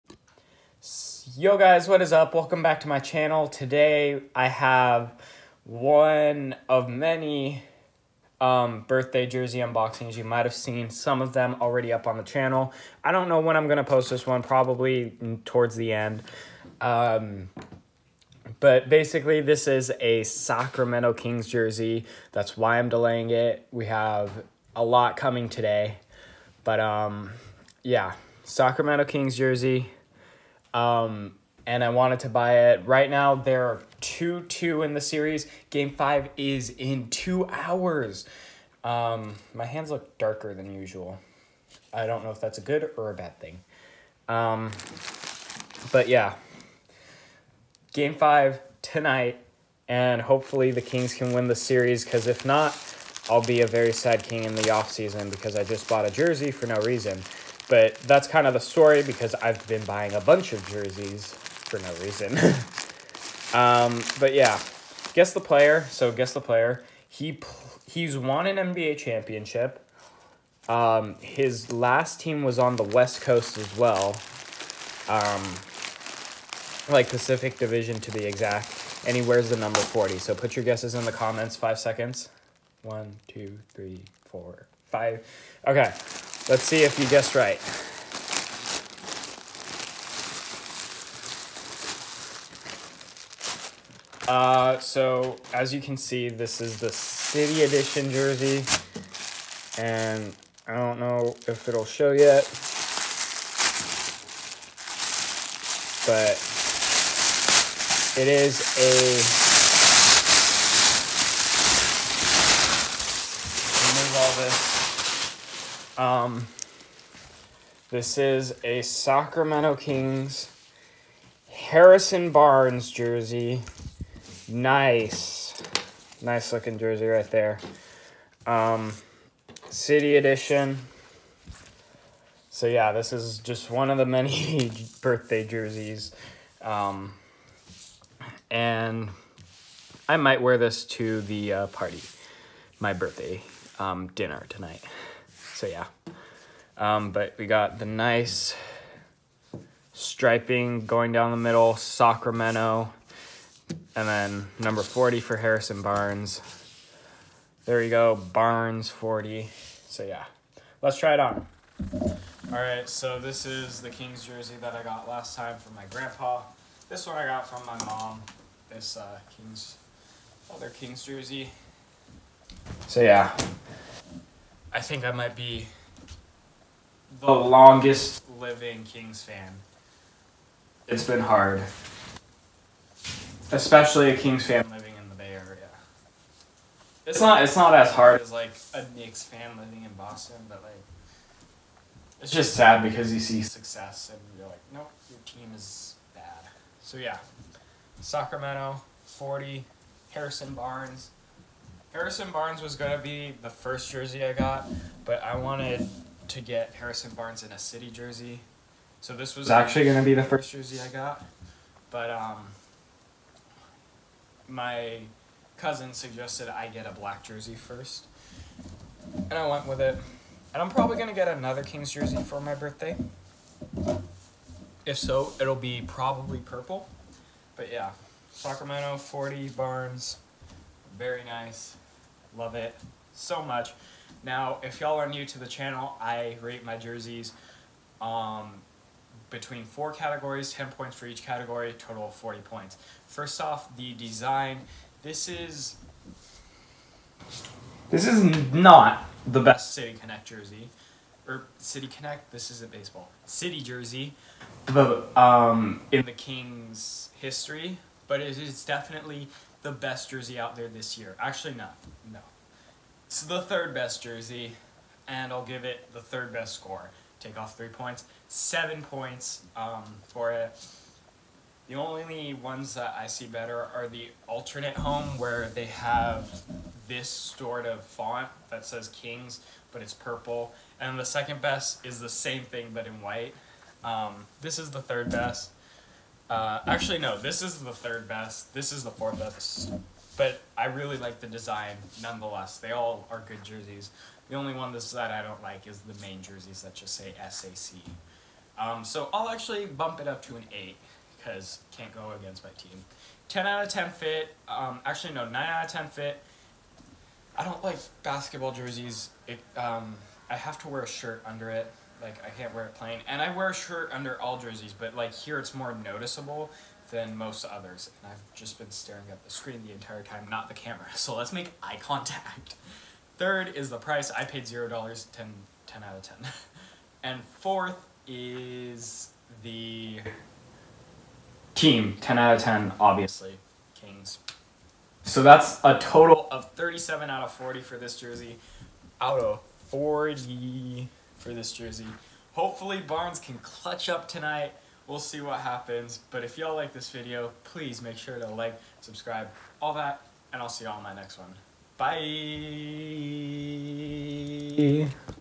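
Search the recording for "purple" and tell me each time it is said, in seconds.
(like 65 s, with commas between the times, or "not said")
226 s, 279 s.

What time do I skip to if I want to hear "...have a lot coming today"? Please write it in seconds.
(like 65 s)
23 s.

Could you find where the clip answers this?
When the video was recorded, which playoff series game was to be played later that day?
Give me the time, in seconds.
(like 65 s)
35 s.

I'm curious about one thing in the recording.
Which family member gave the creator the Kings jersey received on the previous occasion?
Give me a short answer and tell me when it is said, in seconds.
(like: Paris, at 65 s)
grandpa, at 165 s.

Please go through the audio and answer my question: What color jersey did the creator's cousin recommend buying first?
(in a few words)
black.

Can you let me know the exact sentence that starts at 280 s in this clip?
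And the second best is the same thing but in white.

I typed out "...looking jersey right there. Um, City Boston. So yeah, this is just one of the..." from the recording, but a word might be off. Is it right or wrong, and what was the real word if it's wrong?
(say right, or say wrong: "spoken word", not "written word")
wrong: "Edition", not "Boston".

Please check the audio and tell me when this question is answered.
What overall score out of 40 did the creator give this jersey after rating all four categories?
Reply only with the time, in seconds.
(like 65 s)
336 s.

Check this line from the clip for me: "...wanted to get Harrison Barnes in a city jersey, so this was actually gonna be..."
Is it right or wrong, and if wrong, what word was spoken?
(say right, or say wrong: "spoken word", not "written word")
right.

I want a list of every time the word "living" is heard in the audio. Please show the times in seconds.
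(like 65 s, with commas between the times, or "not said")
178 s, 184 s, 189 s.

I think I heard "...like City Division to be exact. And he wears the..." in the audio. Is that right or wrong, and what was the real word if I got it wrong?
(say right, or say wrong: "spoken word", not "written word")
wrong: "Pacific", not "City".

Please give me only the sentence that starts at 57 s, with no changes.
But that's kind of the story because I've been buying a bunch of jerseys for no reason.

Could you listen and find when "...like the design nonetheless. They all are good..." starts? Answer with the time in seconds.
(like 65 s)
290 s.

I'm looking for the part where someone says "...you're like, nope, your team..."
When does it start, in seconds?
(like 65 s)
194 s.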